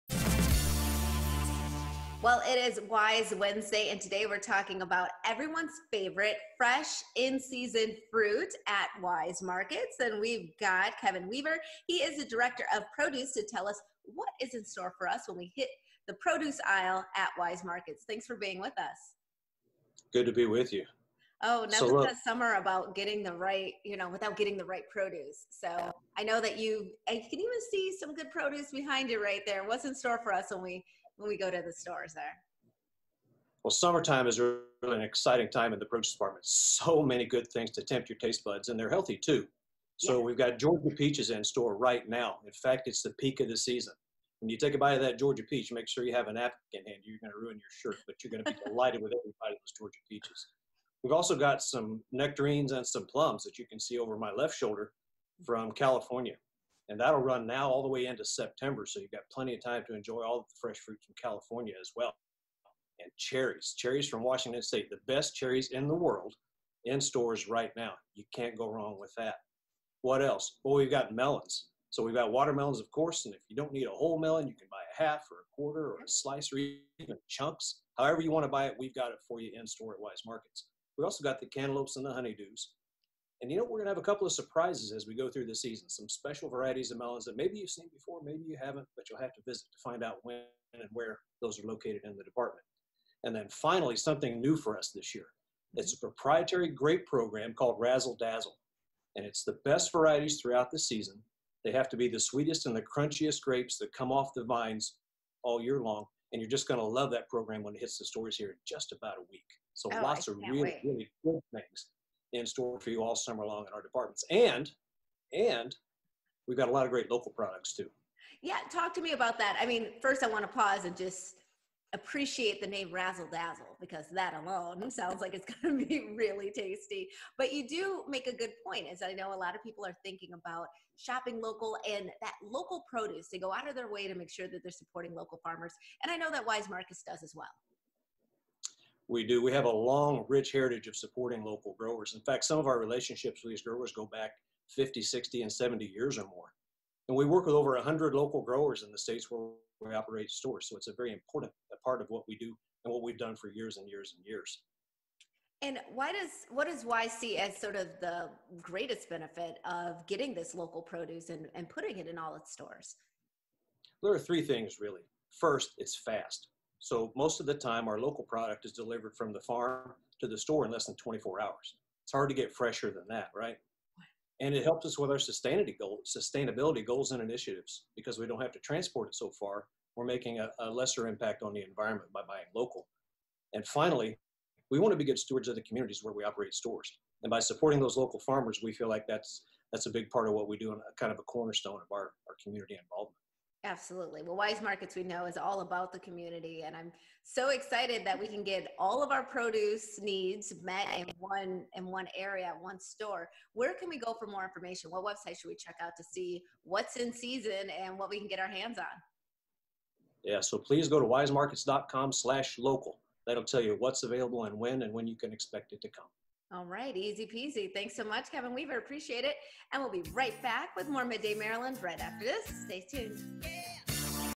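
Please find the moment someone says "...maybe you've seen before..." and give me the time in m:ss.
1:27.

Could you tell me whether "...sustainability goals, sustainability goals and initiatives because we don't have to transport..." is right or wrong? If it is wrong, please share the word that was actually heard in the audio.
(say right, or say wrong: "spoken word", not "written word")
right.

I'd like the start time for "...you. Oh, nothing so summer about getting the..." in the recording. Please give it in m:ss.
0:20.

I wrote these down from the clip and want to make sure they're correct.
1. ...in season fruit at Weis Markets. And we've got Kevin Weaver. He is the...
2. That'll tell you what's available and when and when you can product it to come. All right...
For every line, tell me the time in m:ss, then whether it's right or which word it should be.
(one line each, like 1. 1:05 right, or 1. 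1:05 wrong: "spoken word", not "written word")
1. 0:07 right
2. 3:33 wrong: "expect", not "product".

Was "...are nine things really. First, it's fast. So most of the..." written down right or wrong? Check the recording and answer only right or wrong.
wrong.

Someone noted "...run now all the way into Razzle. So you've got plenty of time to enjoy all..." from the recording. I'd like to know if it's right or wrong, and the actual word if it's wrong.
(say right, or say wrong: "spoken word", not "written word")
wrong: "September", not "Razzle".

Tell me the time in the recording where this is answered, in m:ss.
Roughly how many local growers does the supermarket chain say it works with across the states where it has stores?
2:27.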